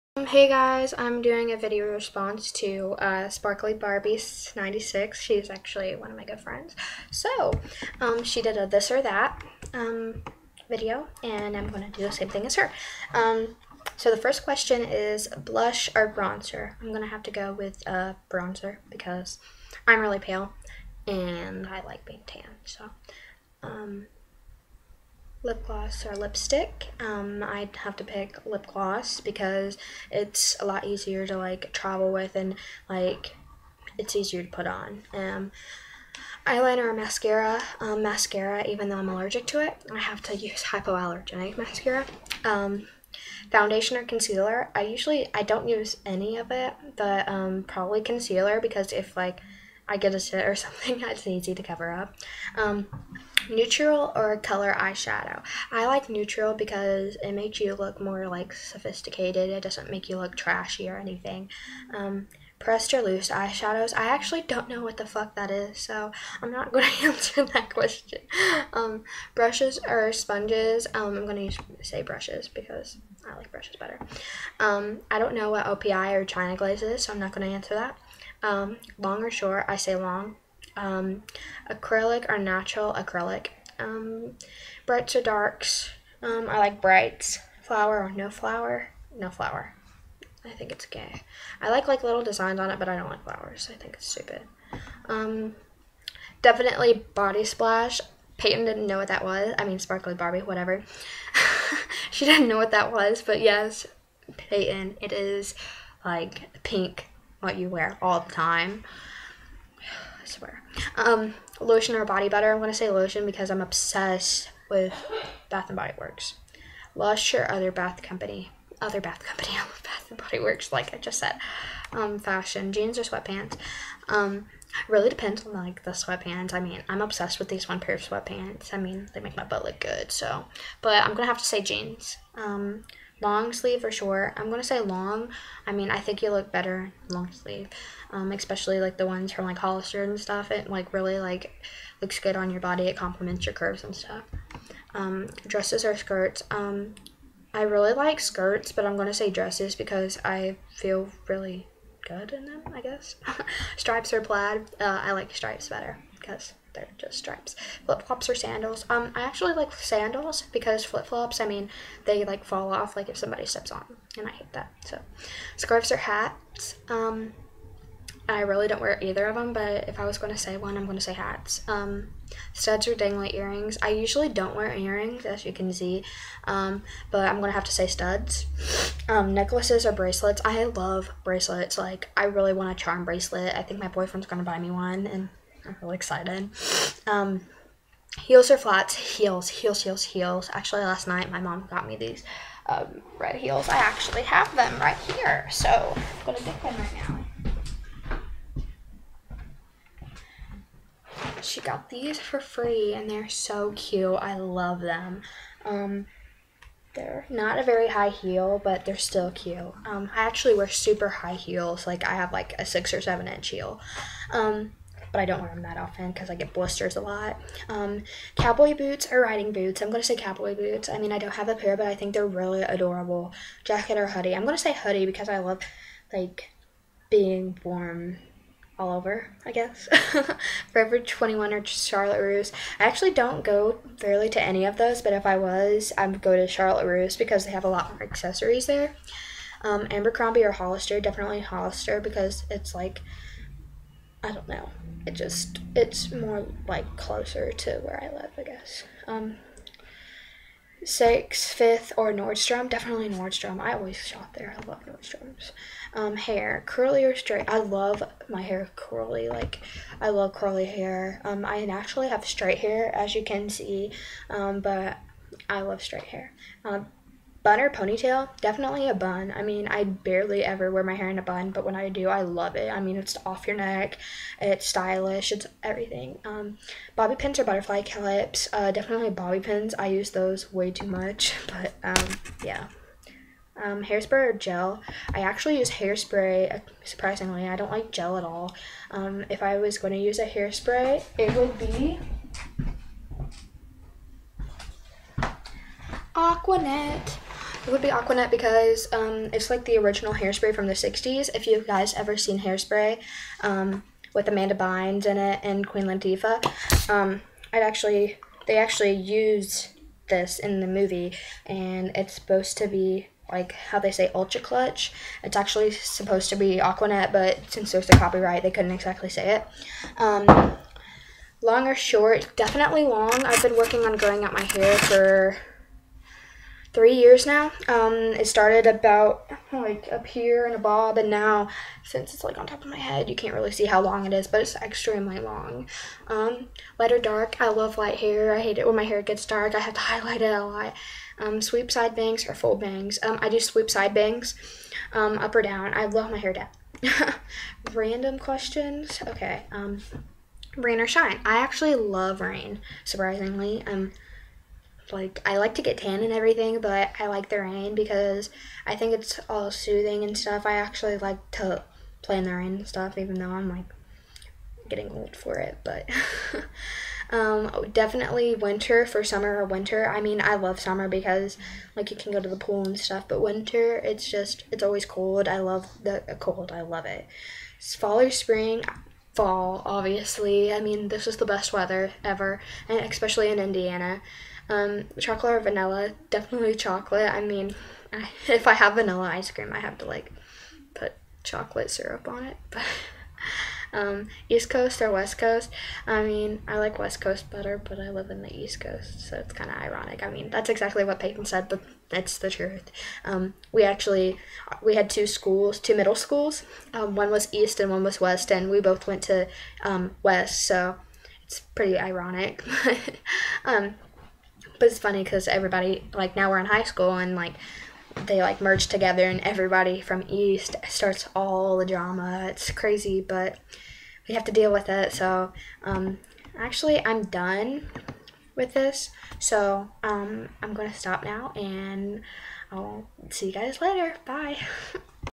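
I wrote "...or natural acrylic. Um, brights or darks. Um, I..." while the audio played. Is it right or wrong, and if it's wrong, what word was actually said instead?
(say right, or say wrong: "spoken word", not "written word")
right.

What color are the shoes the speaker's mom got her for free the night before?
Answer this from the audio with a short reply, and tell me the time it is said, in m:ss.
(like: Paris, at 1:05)
Red, at 3:13.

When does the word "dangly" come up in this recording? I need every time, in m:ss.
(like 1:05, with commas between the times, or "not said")
2:52.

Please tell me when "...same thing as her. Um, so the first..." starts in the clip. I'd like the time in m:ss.
0:12.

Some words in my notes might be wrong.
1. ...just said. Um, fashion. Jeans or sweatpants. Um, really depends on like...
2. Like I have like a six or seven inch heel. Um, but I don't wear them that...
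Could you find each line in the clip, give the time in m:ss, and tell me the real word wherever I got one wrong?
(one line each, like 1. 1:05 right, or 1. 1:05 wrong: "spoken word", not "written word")
1. 2:00 right
2. 3:31 right.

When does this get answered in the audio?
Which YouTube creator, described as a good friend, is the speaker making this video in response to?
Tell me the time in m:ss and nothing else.
0:03.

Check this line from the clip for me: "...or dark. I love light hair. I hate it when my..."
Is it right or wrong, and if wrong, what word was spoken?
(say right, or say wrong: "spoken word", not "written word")
right.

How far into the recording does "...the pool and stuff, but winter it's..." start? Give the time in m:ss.
6:12.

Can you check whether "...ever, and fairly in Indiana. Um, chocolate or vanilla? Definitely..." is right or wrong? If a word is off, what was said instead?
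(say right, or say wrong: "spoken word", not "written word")
wrong: "especially", not "fairly".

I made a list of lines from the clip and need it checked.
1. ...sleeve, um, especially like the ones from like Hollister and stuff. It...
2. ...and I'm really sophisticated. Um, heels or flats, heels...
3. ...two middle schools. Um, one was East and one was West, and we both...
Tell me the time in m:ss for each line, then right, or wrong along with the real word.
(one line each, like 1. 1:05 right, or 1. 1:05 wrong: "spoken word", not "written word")
1. 2:17 right
2. 3:05 wrong: "excited", not "sophisticated"
3. 6:45 right.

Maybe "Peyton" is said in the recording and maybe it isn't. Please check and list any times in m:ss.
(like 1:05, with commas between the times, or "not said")
1:38, 1:44, 6:40.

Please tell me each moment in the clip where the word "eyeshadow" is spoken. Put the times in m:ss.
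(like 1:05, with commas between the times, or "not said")
0:54, 1:03.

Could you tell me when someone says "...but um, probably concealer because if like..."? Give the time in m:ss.
0:46.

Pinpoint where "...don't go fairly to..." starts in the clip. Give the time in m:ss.
3:53.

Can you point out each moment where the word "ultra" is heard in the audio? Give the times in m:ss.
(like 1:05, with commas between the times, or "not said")
5:14.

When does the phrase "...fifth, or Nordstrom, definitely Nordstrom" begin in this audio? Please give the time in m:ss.
4:11.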